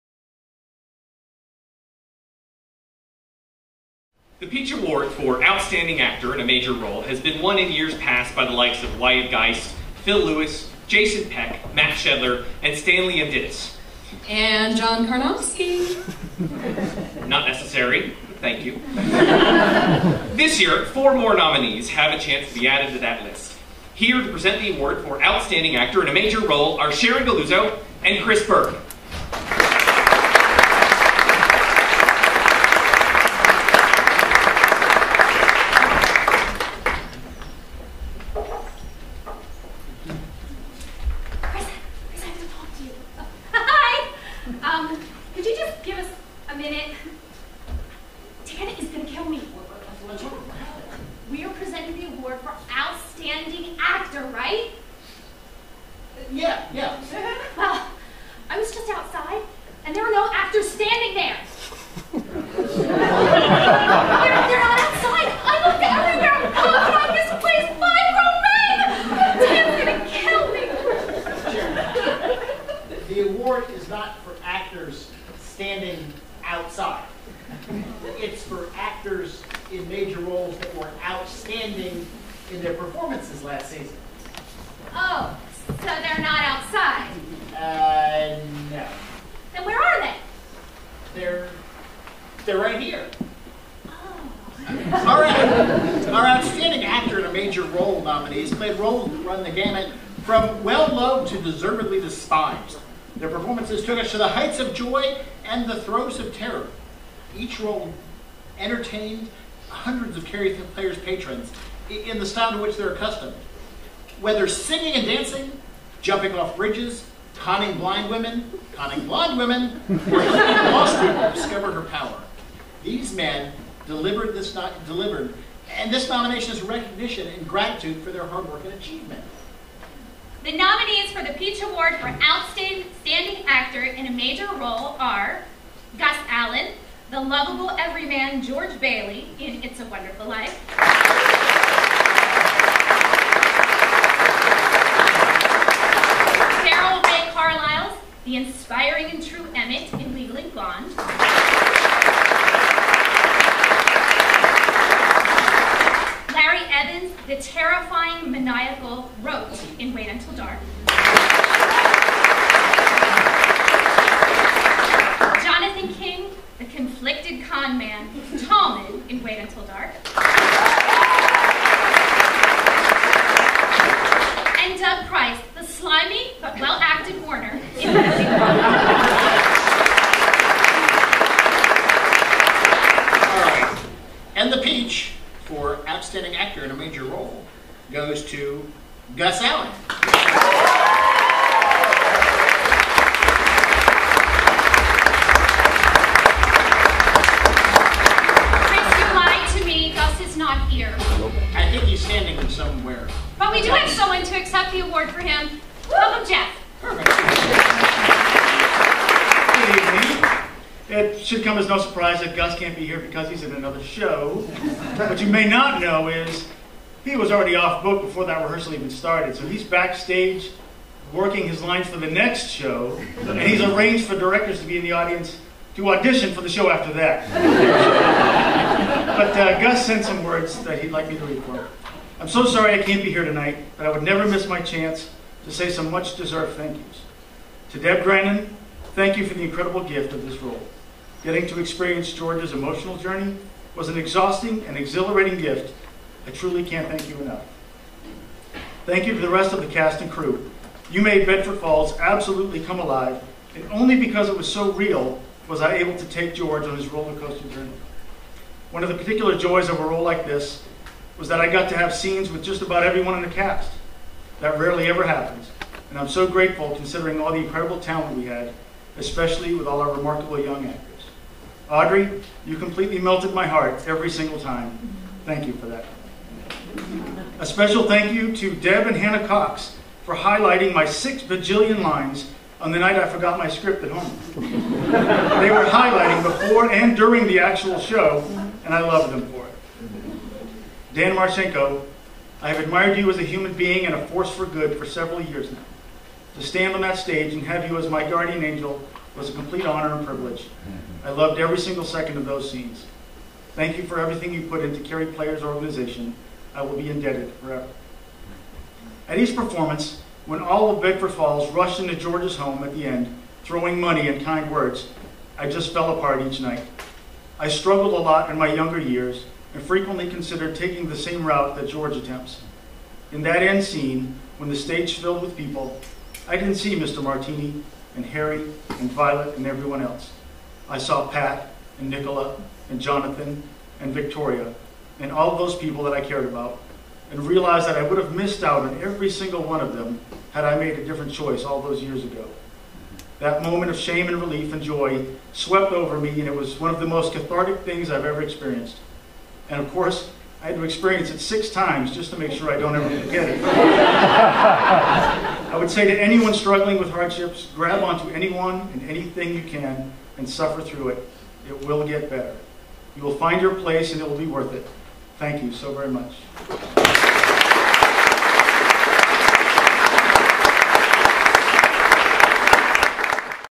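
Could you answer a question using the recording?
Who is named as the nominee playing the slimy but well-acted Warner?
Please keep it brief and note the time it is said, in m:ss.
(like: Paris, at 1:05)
Doug Price, at 2:54.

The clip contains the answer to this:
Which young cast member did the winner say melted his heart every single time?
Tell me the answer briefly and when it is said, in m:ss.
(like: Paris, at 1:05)
Audrey, at 4:31.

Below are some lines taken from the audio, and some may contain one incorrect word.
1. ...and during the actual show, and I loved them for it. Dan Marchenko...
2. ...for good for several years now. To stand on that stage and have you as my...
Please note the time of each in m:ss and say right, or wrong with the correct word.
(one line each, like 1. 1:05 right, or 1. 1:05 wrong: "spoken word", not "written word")
1. 4:46 right
2. 4:54 right.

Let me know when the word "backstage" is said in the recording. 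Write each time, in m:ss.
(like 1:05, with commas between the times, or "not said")
3:39.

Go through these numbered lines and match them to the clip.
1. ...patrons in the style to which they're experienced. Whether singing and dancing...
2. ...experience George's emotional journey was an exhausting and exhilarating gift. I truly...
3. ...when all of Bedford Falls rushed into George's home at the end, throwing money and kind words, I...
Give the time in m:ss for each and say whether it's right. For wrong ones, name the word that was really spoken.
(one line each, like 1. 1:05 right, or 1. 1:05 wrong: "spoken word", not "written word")
1. 1:50 wrong: "accustomed", not "experienced"
2. 4:01 right
3. 5:10 right.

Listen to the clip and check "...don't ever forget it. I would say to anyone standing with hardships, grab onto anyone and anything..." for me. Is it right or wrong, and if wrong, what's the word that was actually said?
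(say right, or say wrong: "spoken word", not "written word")
wrong: "struggling", not "standing".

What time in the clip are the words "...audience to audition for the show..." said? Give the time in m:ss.
3:44.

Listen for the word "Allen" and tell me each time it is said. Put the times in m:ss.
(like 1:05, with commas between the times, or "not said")
2:16, 3:09.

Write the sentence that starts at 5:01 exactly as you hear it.
I loved every single second of those scenes.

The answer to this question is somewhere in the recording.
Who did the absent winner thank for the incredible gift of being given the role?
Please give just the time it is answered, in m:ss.
3:57.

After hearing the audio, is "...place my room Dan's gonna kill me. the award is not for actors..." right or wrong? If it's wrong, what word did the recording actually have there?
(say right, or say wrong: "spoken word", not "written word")
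right.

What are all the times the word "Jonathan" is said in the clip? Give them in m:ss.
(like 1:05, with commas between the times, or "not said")
2:45, 5:32.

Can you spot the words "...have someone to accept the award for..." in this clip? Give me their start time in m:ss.
3:23.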